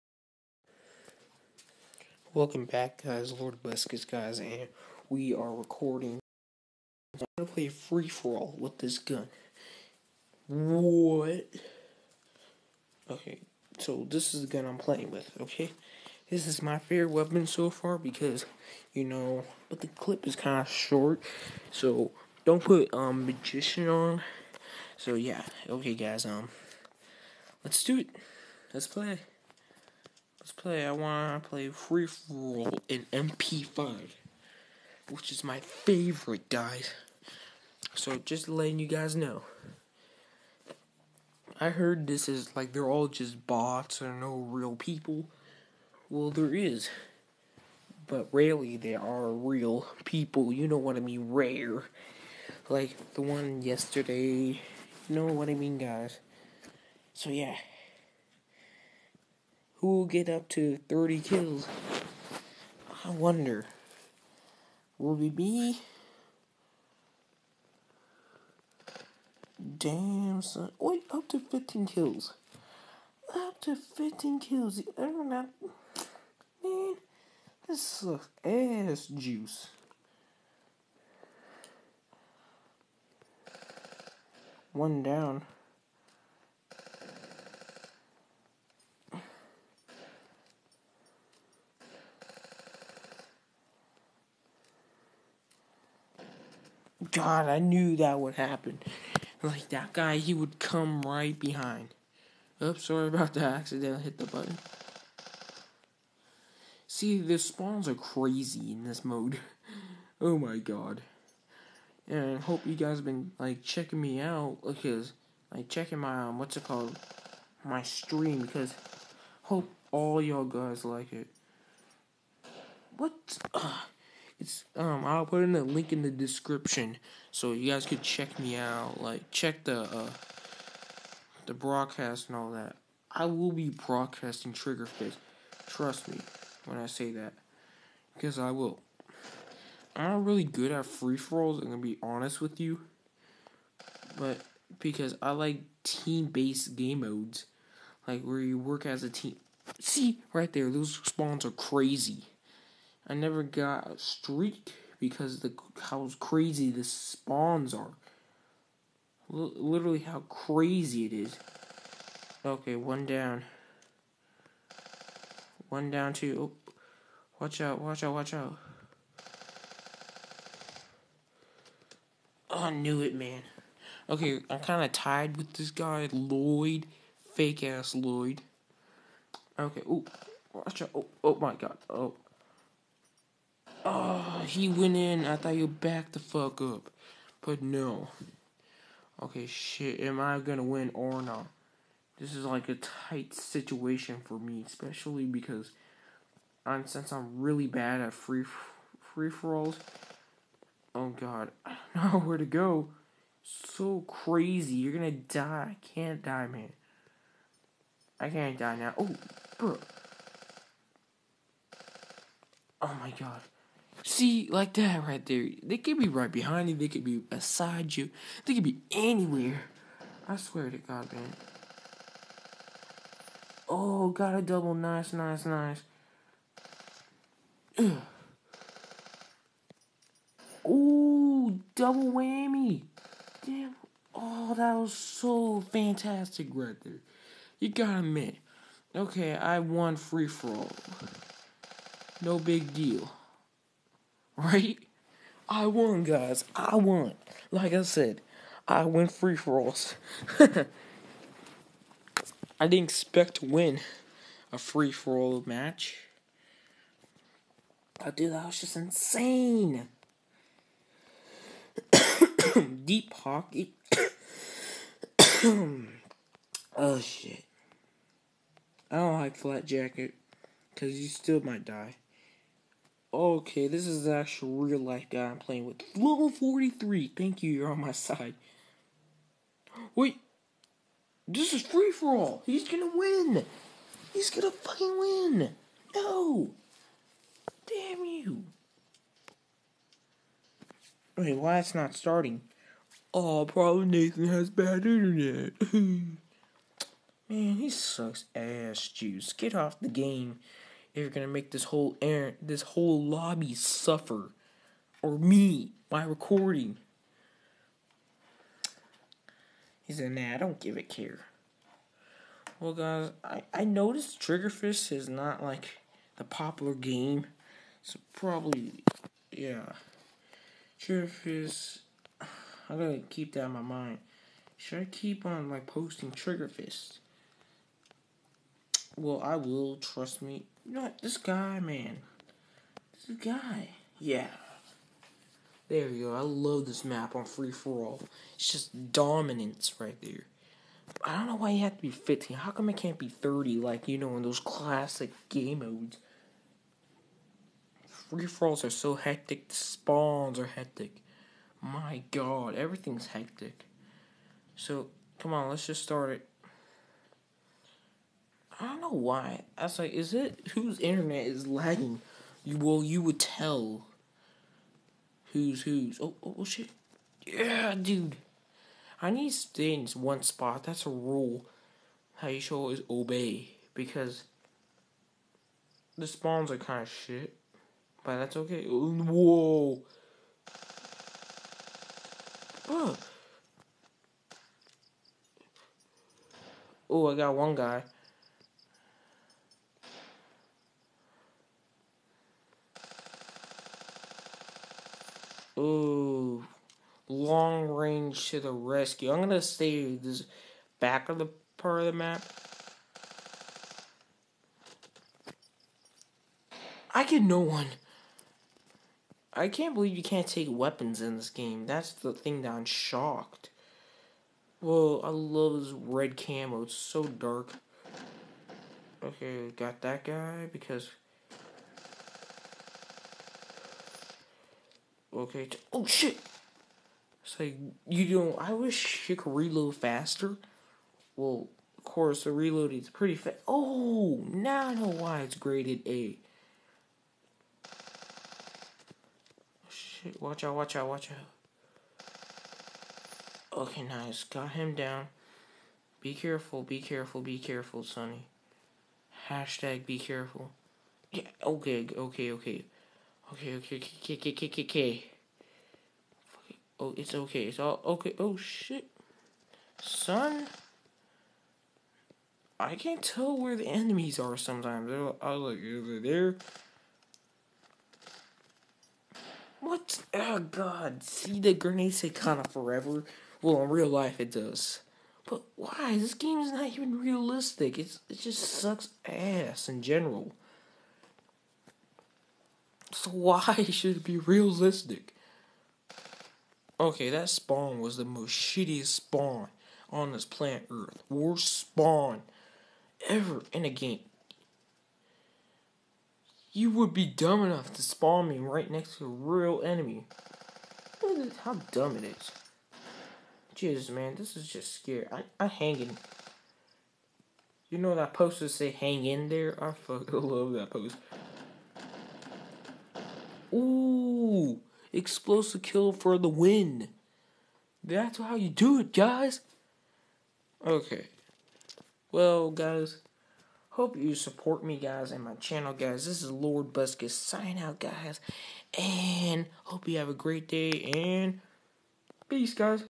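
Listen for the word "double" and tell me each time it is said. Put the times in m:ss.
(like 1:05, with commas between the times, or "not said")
3:44, 3:51.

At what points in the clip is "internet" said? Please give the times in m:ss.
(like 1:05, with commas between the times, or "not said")
4:54, 6:00.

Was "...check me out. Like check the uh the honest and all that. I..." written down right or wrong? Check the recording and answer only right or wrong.
wrong.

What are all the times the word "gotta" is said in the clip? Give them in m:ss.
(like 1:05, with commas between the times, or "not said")
3:57, 5:22.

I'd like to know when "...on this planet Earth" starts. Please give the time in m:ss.
8:09.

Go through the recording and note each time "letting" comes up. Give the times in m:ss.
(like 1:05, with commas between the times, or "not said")
0:38.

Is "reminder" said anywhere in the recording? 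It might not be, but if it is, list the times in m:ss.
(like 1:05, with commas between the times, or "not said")
not said.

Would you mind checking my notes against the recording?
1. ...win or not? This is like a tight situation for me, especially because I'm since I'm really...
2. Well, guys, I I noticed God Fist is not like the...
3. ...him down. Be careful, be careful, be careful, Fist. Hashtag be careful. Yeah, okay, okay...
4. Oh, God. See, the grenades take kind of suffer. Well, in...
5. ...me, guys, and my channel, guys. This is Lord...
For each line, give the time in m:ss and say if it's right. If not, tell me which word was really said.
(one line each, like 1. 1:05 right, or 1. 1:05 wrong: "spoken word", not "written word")
1. 3:10 right
2. 5:12 wrong: "Trigger", not "God"
3. 7:24 wrong: "Sonny", not "Fist"
4. 7:50 wrong: "forever", not "suffer"
5. 8:44 right.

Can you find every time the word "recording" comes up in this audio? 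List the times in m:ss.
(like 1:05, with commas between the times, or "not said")
0:05, 5:06.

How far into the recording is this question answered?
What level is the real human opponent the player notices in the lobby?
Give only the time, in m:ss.
4:35.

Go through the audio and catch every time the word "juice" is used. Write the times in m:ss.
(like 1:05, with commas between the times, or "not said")
1:19, 4:58.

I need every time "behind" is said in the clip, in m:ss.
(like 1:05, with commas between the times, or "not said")
1:41, 3:36.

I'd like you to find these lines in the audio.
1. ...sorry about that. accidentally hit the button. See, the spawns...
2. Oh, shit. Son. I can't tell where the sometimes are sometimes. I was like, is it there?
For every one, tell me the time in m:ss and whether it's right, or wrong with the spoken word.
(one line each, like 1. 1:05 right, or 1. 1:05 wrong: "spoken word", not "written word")
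1. 1:42 right
2. 7:38 wrong: "enemies", not "sometimes".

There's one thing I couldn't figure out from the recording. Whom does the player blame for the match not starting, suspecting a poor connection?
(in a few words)
Nathan.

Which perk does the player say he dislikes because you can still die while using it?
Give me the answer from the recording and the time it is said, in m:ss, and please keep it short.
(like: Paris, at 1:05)
Flak Jacket, at 4:29.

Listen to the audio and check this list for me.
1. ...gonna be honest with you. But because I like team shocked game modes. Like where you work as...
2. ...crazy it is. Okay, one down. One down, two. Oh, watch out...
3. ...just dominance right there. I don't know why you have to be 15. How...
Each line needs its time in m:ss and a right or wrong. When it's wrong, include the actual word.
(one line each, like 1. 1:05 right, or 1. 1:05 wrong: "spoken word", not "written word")
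1. 2:21 wrong: "based", not "shocked"
2. 2:40 right
3. 5:38 right.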